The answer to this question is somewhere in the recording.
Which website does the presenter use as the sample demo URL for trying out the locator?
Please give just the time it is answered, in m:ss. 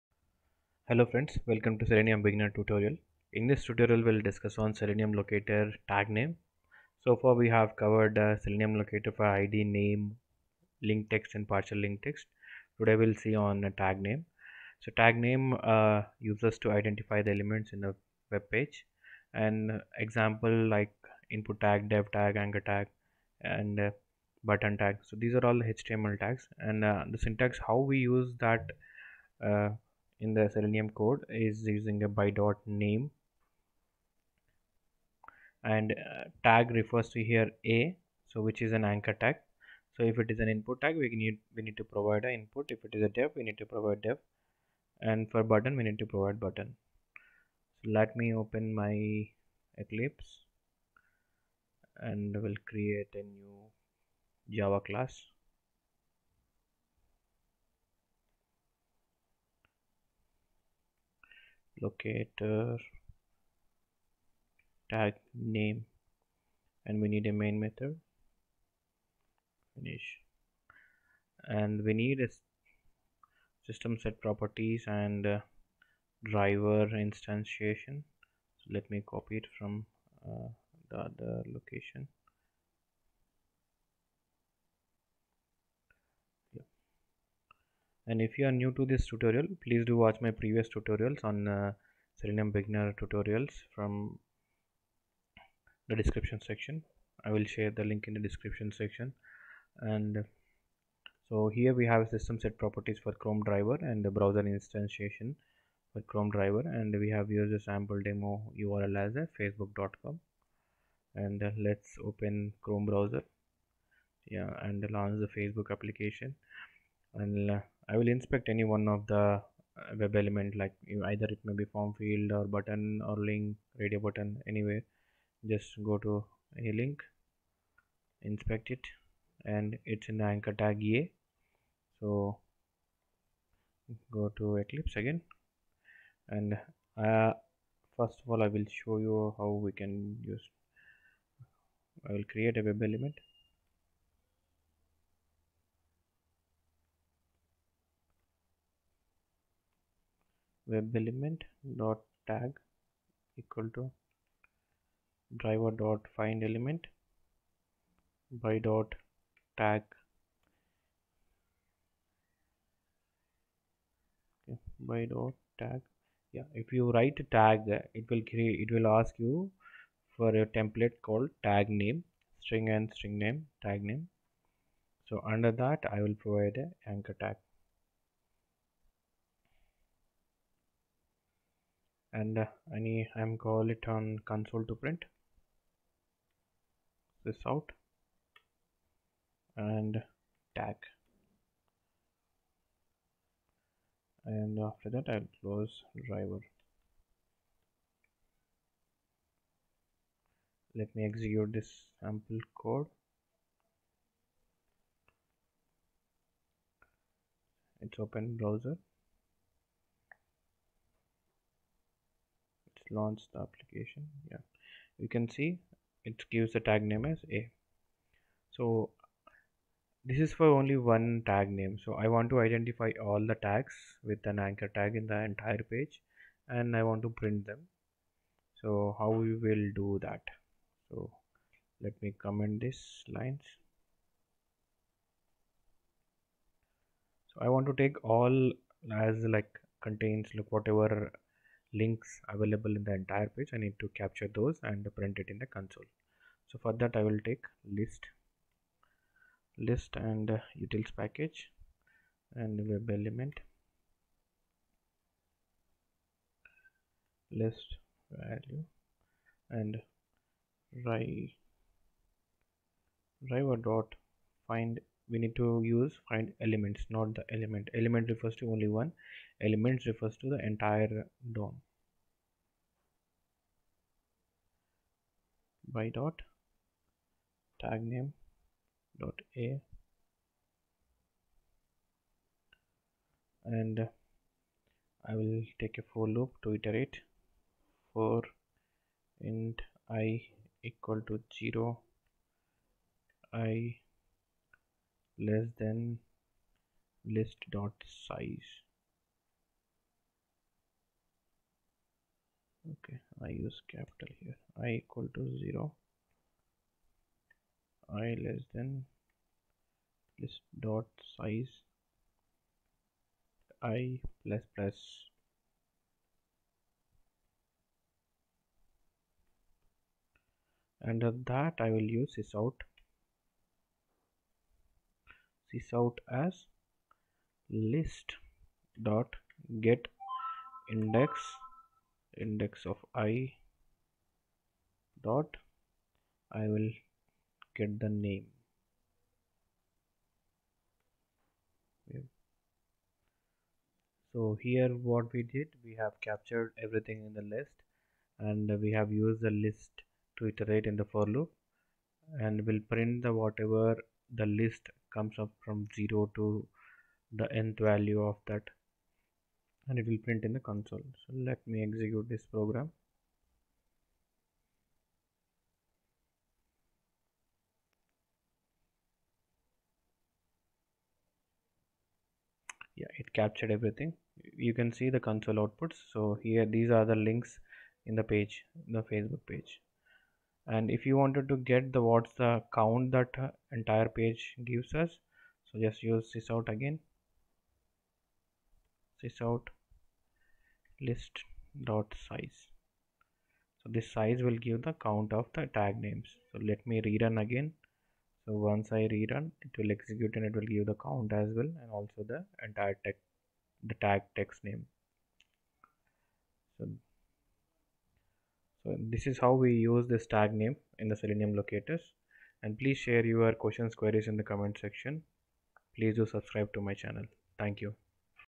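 1:49.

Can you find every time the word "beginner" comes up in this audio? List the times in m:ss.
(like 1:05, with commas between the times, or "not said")
0:02, 1:32.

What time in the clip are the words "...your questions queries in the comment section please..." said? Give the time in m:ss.
6:53.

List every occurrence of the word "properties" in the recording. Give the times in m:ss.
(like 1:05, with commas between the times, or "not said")
1:14, 1:42.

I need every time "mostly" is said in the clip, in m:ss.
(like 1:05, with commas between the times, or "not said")
not said.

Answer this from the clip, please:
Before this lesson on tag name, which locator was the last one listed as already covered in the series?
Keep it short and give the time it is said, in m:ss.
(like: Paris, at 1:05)
partial link text, at 0:11.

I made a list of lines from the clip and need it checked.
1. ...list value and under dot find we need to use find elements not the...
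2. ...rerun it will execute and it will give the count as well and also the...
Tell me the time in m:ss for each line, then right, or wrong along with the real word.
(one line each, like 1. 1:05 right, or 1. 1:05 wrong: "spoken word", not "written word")
1. 4:17 wrong: "driver", not "under"
2. 6:38 right.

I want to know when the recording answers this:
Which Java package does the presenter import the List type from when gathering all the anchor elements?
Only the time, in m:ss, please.
4:10.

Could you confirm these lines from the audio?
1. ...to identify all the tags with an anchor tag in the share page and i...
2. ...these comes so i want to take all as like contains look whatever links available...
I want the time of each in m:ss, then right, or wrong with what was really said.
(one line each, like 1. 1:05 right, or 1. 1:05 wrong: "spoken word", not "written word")
1. 3:42 wrong: "entire", not "share"
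2. 3:52 wrong: "lines", not "comes".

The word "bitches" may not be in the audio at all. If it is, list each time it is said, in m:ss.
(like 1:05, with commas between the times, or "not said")
not said.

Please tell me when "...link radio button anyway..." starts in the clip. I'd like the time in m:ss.
2:03.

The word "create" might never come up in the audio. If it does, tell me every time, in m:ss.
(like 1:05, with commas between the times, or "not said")
0:52, 2:22, 2:48.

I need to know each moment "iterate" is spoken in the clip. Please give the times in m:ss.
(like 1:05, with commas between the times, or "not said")
4:46, 5:50.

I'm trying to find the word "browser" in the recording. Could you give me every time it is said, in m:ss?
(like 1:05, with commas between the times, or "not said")
1:44, 1:52, 3:28.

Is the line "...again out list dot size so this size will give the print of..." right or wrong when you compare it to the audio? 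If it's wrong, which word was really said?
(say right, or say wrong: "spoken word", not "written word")
wrong: "count", not "print".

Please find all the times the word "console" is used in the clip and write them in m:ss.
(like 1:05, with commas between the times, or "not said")
3:04, 4:05, 6:00, 6:14.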